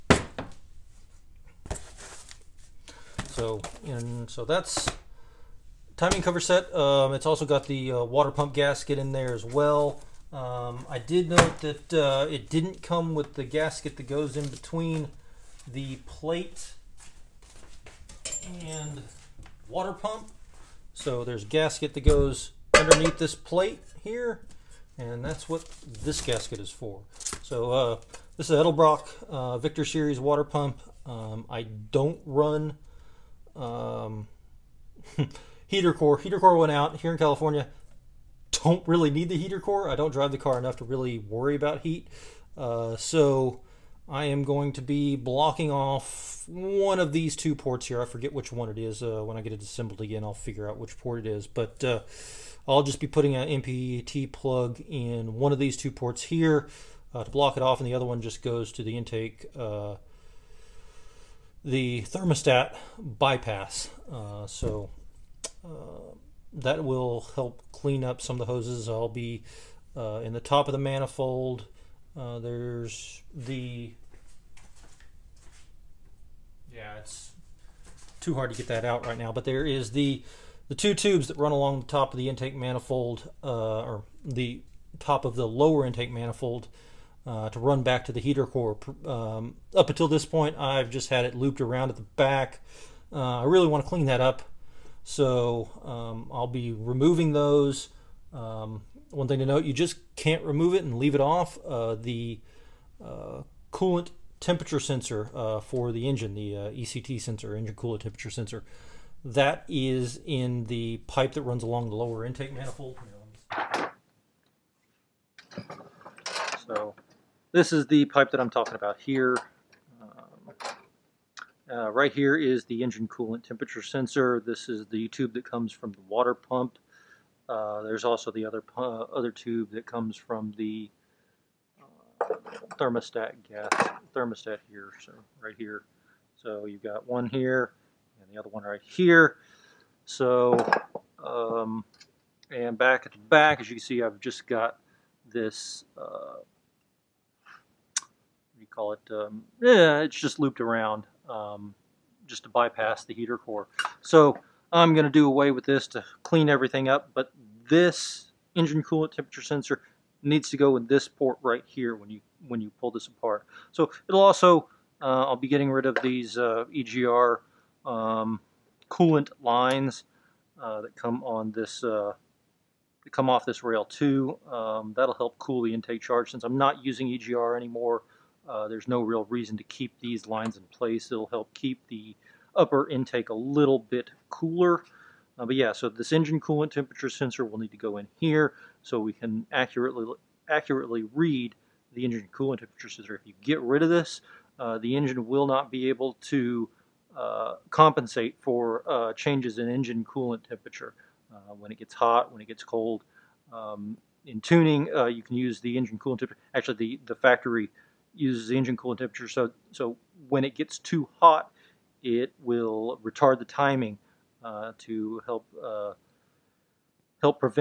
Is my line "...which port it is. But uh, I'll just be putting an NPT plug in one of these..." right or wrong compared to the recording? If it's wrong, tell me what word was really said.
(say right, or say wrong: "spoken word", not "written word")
right.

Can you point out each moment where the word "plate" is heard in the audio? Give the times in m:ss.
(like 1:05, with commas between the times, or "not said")
0:16, 0:23.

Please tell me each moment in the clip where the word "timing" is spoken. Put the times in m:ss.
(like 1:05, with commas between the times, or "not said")
0:05, 3:33.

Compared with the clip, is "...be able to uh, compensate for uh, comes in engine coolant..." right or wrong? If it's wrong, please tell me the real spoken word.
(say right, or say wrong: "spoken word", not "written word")
wrong: "changes", not "comes".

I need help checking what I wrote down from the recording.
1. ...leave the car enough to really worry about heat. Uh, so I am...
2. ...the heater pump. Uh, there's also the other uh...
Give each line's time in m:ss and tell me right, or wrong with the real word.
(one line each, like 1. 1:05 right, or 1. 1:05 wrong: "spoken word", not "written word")
1. 0:40 wrong: "drive", not "leave"
2. 2:05 wrong: "water", not "heater".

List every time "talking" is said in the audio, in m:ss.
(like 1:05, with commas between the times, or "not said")
1:58.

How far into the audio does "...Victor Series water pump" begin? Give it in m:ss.
0:29.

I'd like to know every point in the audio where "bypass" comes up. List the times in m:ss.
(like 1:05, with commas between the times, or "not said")
1:02, 2:32.